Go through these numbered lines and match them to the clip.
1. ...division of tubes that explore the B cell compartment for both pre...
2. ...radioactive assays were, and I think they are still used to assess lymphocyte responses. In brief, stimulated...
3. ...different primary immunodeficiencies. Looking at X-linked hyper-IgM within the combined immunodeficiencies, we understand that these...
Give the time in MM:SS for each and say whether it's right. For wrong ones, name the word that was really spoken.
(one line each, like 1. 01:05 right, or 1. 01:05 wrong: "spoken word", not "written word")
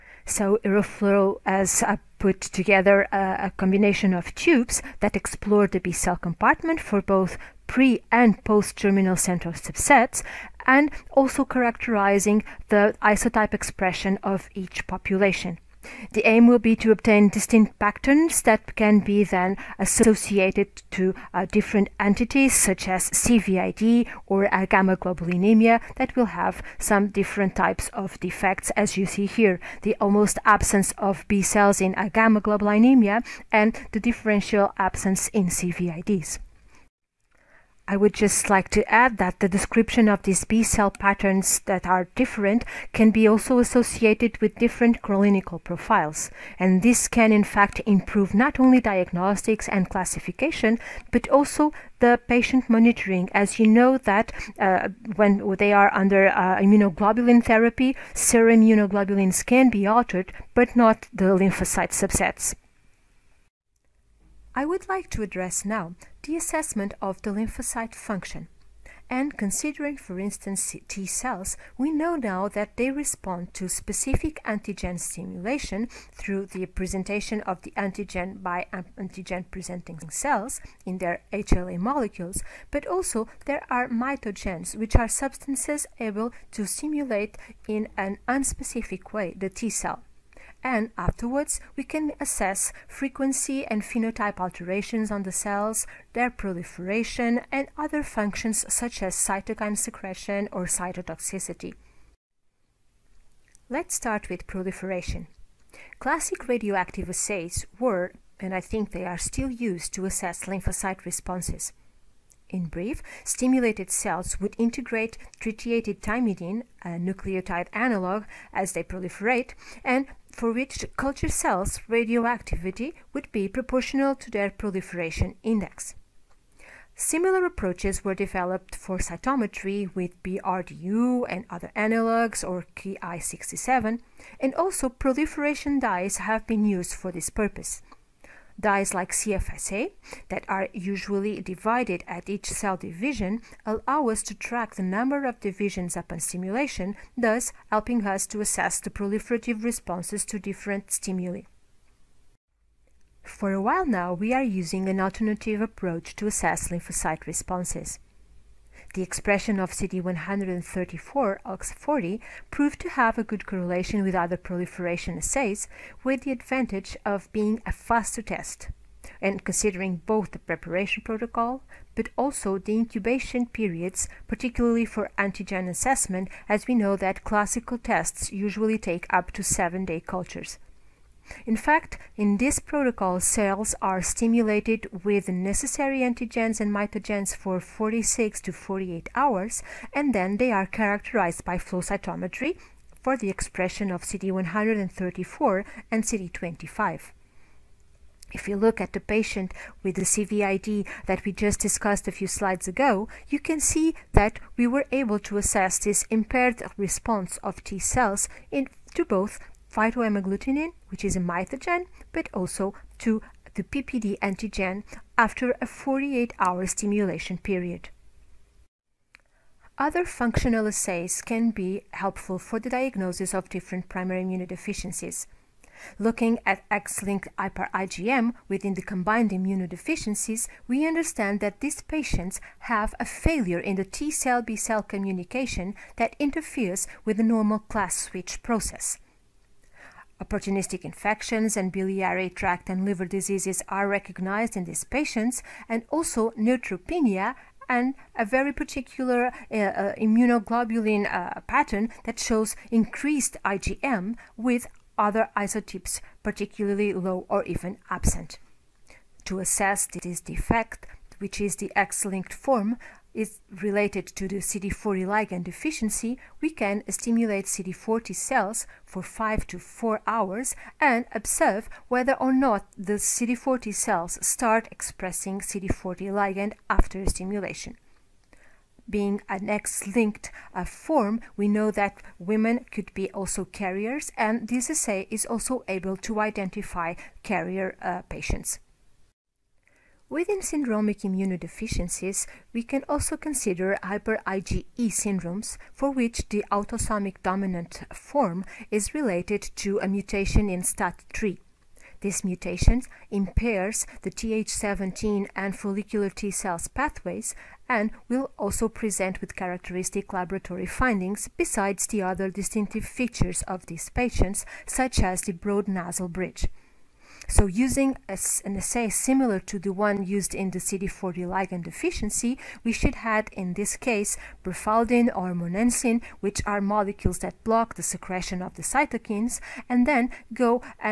1. 00:03 wrong: "combination", not "division"
2. 01:46 right
3. 03:43 right.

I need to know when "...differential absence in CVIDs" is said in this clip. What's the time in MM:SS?
00:34.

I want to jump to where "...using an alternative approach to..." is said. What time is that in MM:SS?
02:34.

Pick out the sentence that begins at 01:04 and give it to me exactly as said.
I would like to address now the assessment of the lymphocyte function.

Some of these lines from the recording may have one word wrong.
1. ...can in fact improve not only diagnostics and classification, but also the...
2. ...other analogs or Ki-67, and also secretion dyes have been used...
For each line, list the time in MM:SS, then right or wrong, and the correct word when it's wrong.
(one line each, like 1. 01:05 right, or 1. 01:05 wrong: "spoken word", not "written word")
1. 00:47 right
2. 02:11 wrong: "proliferation", not "secretion".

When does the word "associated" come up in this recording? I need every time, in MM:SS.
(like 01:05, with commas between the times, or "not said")
00:19, 00:43.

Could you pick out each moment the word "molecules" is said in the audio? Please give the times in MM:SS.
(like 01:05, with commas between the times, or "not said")
01:21, 05:26.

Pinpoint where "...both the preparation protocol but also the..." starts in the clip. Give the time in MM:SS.
02:50.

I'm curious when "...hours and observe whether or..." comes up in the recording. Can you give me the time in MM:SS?
04:30.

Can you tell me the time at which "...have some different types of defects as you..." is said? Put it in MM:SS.
00:26.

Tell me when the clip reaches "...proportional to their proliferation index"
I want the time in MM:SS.
02:03.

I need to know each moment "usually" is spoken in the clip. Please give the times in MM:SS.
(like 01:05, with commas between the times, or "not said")
02:20, 02:58.